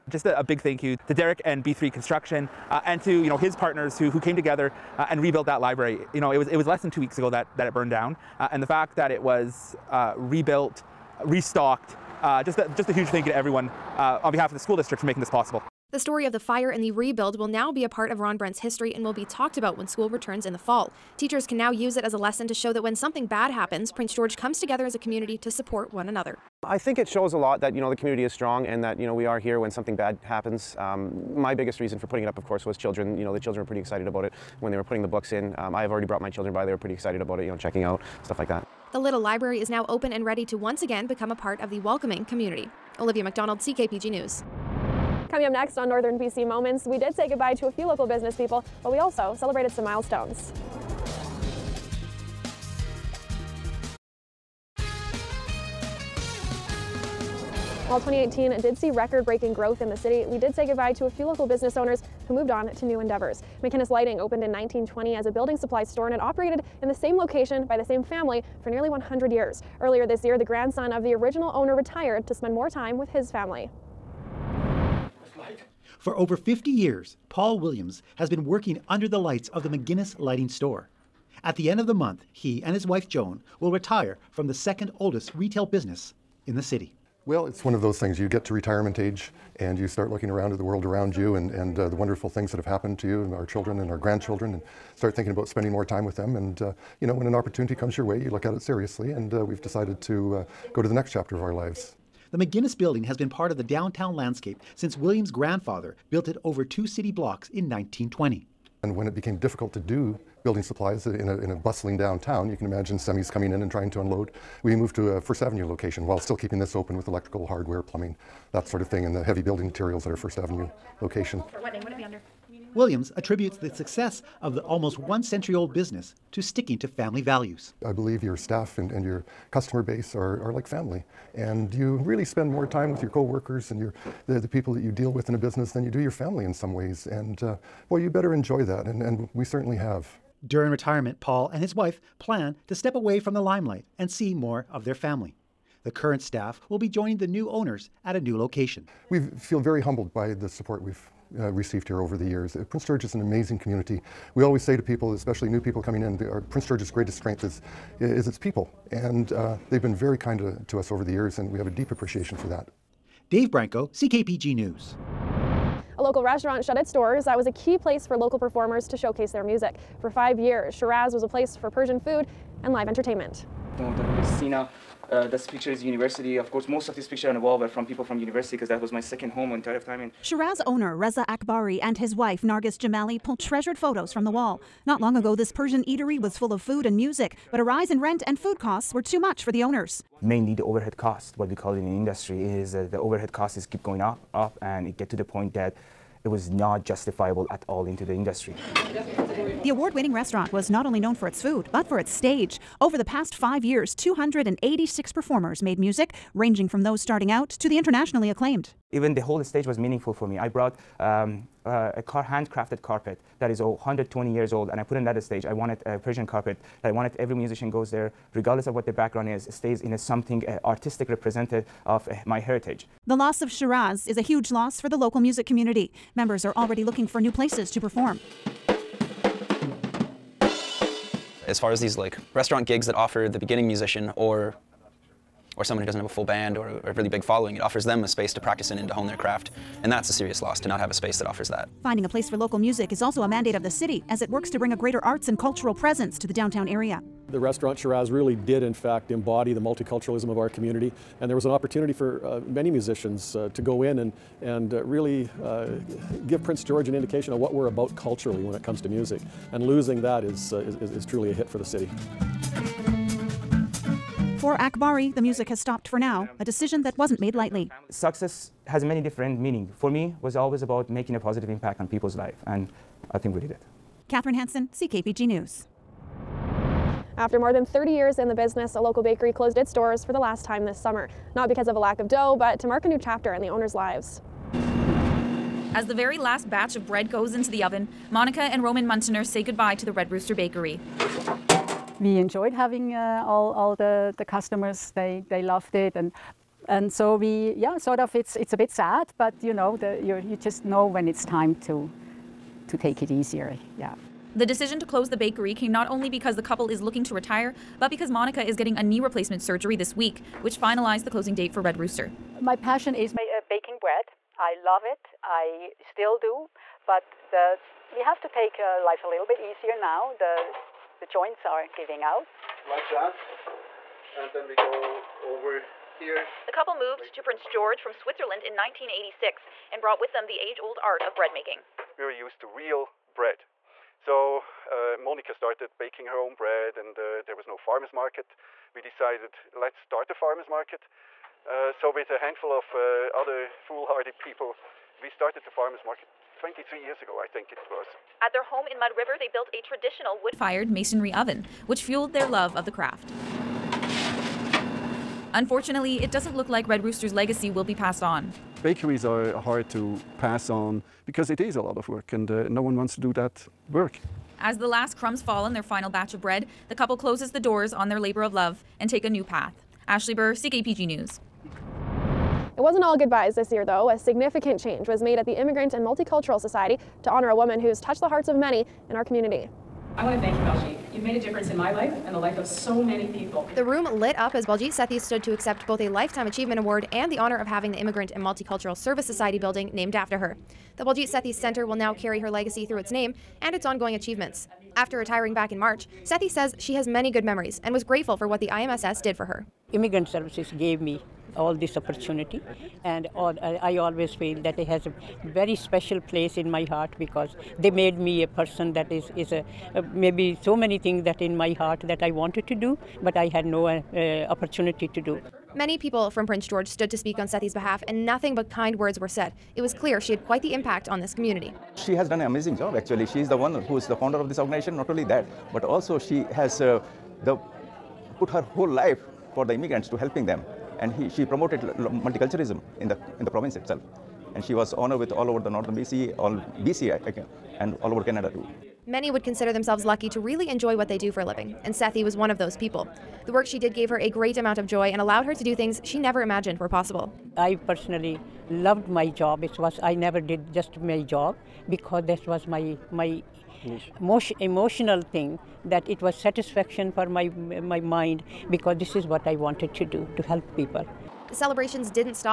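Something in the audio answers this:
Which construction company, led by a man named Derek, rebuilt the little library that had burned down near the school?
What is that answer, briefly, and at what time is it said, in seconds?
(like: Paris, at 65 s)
B3 Construction, at 1 s.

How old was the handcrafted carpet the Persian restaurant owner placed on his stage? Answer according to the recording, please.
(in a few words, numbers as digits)
120 years.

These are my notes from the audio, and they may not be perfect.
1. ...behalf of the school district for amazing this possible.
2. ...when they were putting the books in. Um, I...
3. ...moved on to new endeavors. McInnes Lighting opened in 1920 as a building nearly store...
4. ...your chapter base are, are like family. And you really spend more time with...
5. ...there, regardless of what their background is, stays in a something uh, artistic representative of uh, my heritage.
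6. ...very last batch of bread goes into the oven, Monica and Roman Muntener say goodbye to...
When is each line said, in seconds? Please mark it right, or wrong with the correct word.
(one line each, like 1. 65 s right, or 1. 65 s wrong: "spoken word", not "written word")
1. 14 s wrong: "making", not "amazing"
2. 34 s right
3. 62 s wrong: "supply", not "nearly"
4. 129 s wrong: "customer", not "chapter"
5. 217 s right
6. 285 s right.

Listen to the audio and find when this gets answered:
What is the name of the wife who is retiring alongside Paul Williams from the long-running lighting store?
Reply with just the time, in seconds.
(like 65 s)
83 s.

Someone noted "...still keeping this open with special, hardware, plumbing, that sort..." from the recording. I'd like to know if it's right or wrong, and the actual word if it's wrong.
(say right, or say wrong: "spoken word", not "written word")
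wrong: "electrical", not "special".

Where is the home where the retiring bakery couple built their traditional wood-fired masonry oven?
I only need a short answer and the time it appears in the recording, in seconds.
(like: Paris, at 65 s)
Mud River, at 348 s.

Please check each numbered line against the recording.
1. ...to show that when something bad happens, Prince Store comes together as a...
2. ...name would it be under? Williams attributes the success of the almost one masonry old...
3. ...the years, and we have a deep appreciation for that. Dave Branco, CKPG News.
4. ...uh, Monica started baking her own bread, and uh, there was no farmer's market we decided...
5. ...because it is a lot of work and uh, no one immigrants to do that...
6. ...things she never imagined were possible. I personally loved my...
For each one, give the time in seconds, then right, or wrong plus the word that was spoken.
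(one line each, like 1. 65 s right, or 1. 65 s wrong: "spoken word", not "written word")
1. 22 s wrong: "George", not "Store"
2. 121 s wrong: "century", not "masonry"
3. 161 s right
4. 334 s right
5. 361 s wrong: "wants", not "immigrants"
6. 445 s right.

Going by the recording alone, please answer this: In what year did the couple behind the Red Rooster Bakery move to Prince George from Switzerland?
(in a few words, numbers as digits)
1986.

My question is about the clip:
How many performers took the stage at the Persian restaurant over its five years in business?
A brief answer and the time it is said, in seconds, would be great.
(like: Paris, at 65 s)
286, at 203 s.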